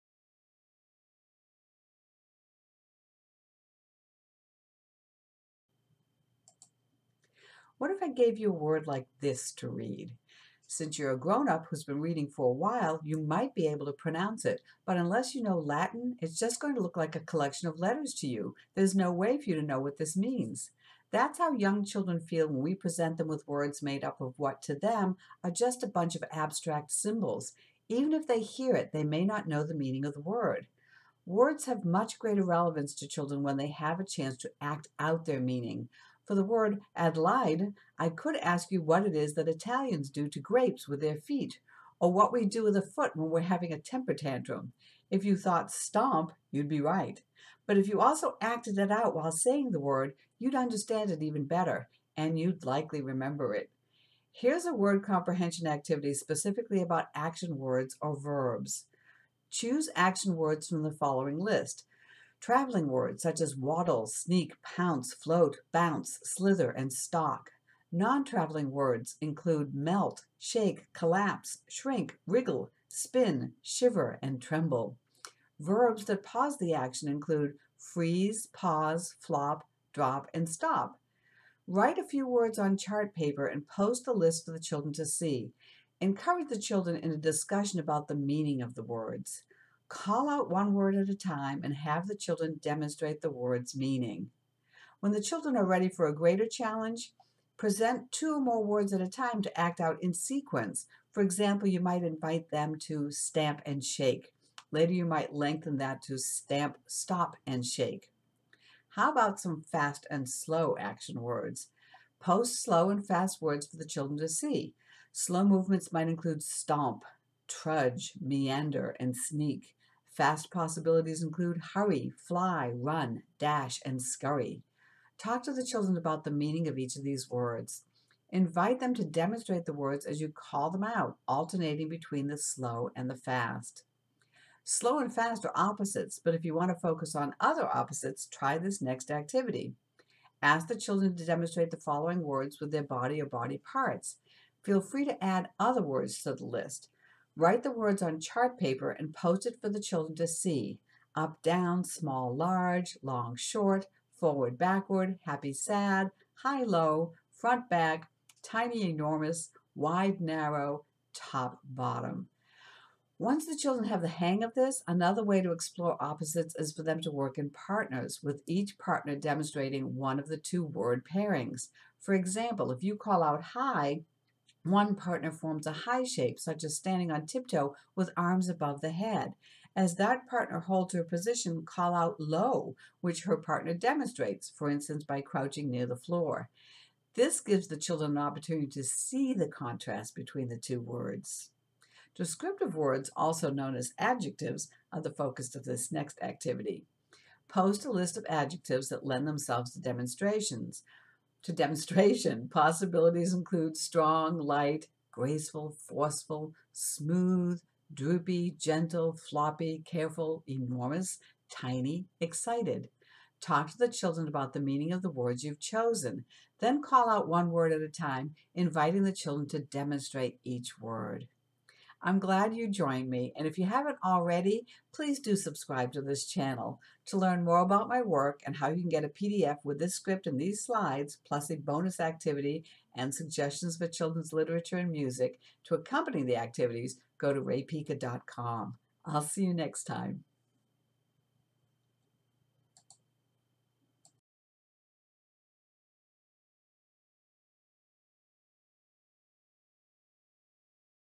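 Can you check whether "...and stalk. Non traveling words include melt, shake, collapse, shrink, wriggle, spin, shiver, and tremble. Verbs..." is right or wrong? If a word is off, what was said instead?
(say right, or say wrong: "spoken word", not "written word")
right.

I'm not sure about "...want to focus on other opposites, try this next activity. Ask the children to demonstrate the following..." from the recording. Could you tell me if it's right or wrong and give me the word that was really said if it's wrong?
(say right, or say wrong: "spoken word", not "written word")
right.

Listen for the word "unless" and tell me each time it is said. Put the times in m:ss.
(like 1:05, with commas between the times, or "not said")
0:14.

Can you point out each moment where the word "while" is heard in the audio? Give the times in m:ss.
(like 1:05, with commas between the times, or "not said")
0:12, 0:49.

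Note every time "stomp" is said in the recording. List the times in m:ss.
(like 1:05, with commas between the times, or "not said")
0:45, 1:56.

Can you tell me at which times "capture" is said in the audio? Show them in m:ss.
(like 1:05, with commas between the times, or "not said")
not said.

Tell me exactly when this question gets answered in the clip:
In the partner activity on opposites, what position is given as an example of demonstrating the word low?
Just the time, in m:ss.
3:05.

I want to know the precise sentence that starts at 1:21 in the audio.
Write a few words on chart paper and post the list for the children to see.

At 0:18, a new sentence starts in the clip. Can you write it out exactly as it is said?
There's no way for you to know what this means.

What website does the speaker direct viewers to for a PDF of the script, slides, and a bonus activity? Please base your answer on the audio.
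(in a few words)
raepica.com.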